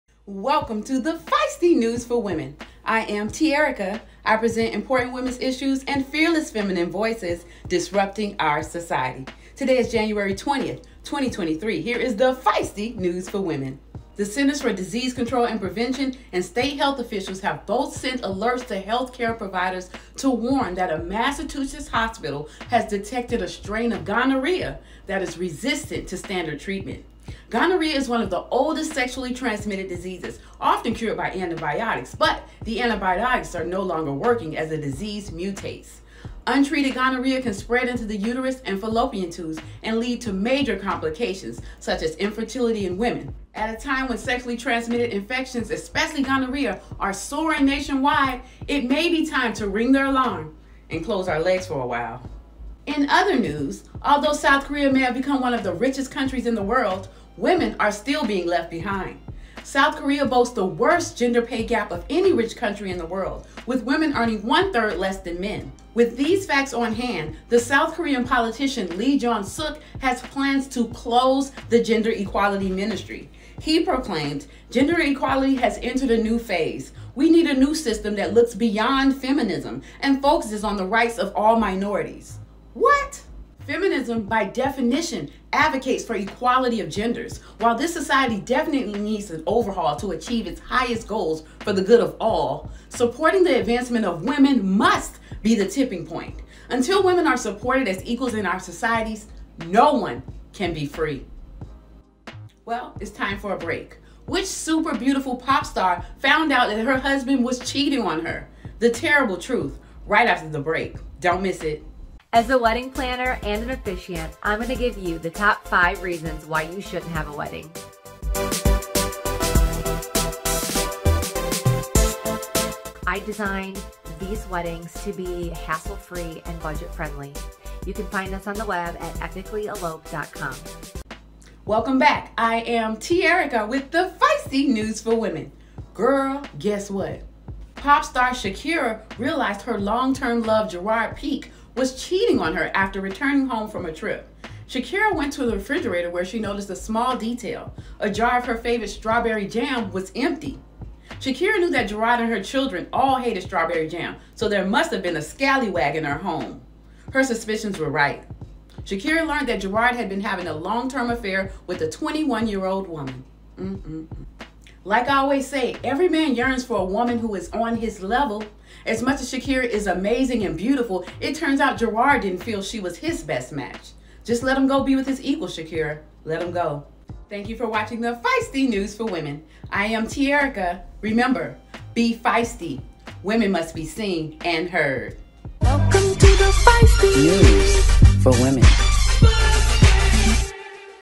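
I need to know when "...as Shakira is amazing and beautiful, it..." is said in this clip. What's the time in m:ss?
2:49.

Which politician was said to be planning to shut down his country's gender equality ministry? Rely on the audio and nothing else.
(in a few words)
Lee Jong Suk.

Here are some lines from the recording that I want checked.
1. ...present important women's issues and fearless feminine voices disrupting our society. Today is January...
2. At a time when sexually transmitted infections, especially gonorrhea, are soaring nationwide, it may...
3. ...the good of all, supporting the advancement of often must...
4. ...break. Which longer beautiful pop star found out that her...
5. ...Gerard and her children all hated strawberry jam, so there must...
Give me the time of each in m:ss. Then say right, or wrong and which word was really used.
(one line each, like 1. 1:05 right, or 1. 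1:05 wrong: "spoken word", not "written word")
1. 0:04 right
2. 0:43 right
3. 1:31 wrong: "women", not "often"
4. 1:43 wrong: "super", not "longer"
5. 2:31 right.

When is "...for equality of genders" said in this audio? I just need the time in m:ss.
1:26.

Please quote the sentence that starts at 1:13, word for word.
He proclaimed, Gender equality has entered a new phase.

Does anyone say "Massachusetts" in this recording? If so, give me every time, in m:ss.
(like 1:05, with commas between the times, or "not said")
0:20.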